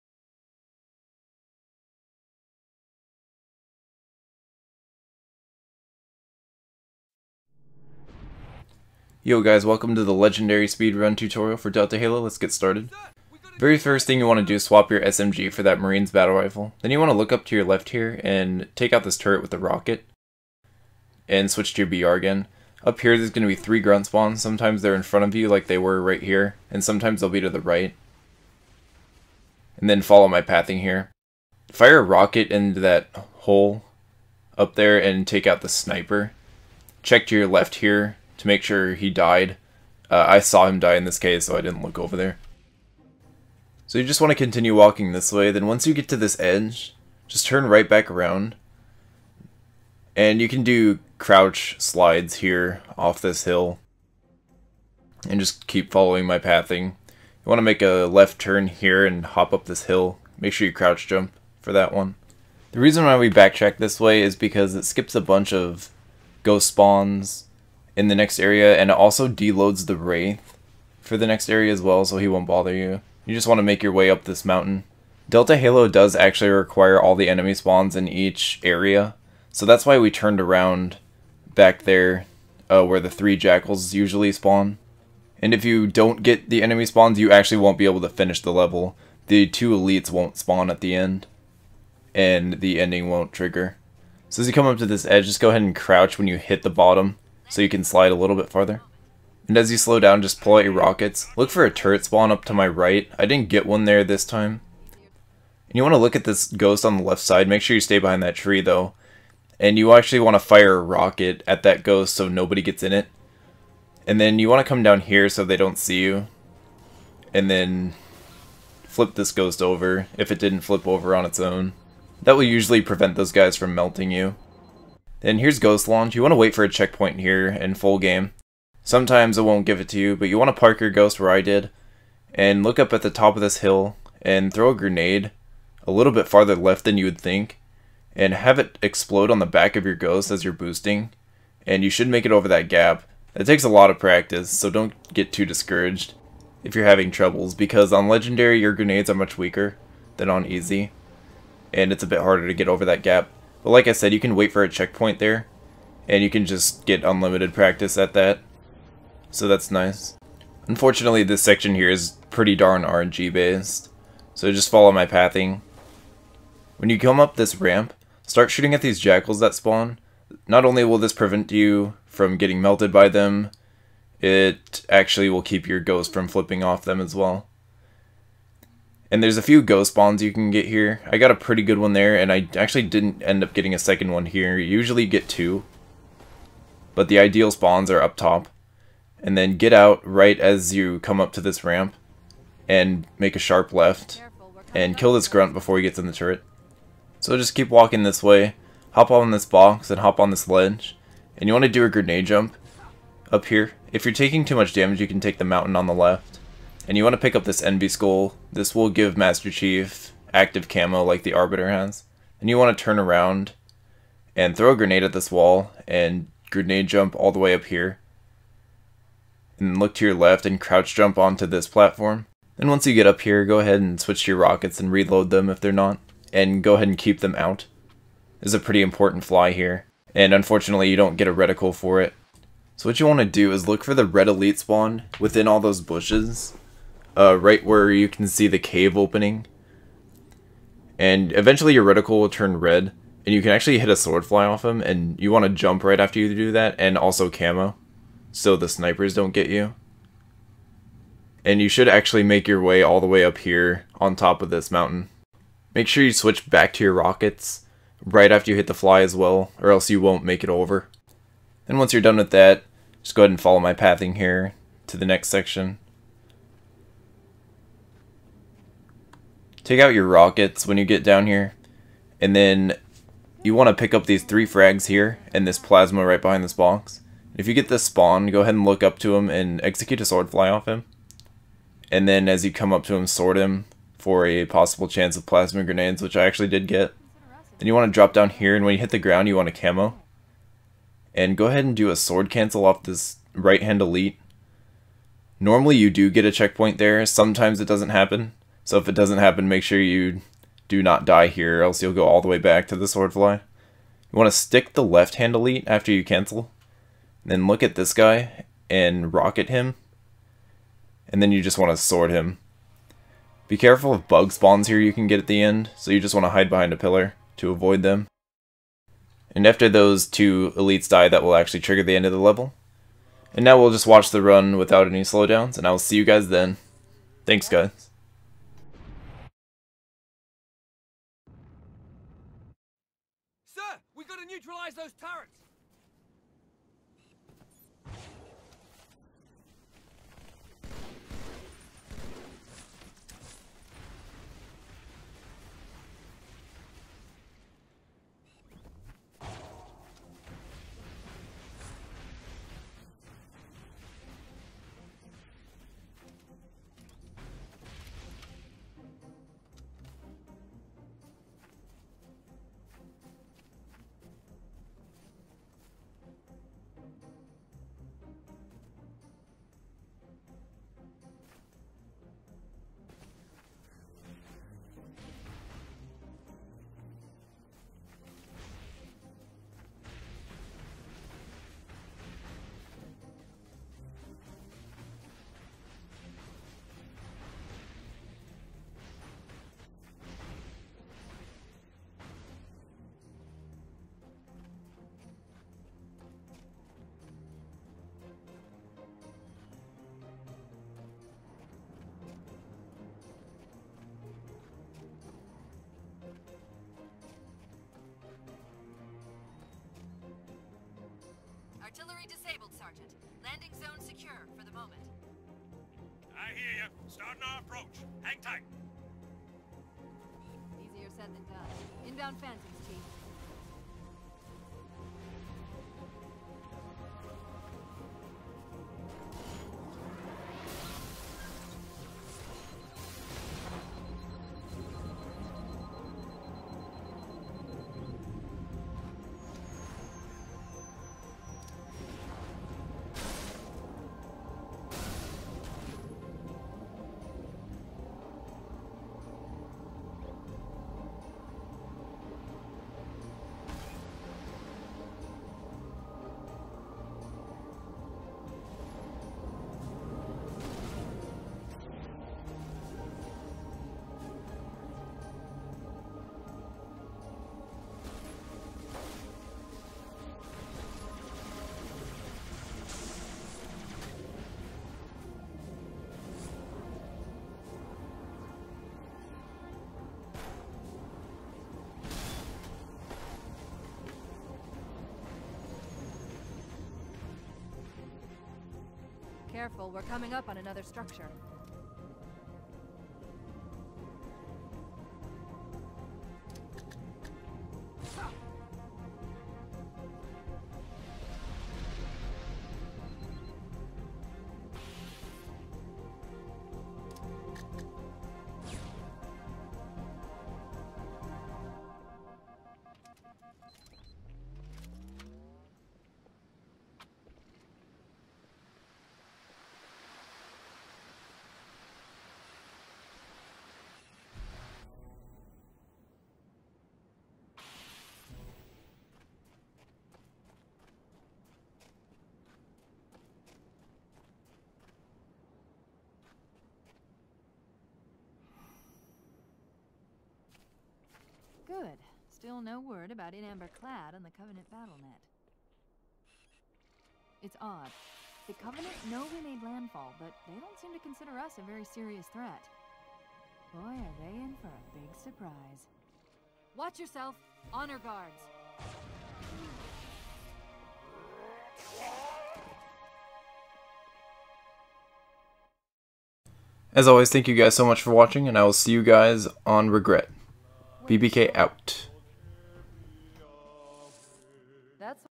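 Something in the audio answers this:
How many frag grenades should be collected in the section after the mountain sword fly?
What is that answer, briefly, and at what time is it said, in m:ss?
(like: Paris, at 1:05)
3, at 4:34.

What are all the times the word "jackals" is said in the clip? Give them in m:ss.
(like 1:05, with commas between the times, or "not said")
1:23, 2:48.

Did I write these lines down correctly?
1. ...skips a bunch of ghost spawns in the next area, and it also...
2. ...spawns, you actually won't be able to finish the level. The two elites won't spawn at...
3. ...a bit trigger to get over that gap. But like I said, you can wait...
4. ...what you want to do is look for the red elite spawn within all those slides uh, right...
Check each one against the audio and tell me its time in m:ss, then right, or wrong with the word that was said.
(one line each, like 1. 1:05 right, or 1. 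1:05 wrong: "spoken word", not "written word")
1. 1:04 right
2. 1:26 right
3. 2:32 wrong: "harder", not "trigger"
4. 3:52 wrong: "bushes", not "slides".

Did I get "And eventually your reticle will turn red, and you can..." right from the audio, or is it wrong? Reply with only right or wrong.
right.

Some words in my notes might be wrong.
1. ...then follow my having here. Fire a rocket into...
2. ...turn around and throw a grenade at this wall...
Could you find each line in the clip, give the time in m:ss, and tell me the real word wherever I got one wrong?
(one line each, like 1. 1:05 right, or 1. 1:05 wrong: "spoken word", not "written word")
1. 0:29 wrong: "pathing", not "having"
2. 3:32 right.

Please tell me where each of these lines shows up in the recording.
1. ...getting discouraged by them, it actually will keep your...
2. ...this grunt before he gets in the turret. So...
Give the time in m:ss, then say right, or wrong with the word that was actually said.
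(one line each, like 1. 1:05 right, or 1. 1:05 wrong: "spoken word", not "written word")
1. 2:52 wrong: "melted", not "discouraged"
2. 3:15 right.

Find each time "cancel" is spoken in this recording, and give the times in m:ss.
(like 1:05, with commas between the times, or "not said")
4:52, 5:06.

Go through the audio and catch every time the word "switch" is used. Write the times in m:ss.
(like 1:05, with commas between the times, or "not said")
0:21, 3:43, 4:16.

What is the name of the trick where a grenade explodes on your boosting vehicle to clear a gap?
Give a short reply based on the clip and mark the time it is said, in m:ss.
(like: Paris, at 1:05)
Ghost Launch, at 2:05.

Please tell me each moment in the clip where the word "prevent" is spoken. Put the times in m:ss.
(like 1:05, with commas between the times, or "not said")
2:02, 2:51.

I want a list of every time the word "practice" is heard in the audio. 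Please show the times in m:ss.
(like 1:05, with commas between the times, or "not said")
2:23, 2:37.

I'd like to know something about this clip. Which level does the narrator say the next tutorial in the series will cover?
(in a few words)
Regret.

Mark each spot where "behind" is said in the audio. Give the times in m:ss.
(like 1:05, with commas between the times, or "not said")
1:47, 4:36, 5:16.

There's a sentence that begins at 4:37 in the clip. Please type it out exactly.
If you get this spawn, go ahead and look up to him and execute a sword fly off him.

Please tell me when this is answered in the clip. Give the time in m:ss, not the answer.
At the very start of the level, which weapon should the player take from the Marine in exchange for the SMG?
0:16.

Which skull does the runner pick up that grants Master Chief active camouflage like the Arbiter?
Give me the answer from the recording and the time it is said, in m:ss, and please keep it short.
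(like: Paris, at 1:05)
Envy Skull, at 3:27.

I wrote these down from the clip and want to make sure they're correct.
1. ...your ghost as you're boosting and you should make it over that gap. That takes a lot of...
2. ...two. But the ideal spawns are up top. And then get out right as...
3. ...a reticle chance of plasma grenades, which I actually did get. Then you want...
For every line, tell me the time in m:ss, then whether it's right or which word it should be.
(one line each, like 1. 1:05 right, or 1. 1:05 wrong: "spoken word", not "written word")
1. 2:19 right
2. 3:05 right
3. 4:44 wrong: "possible", not "reticle".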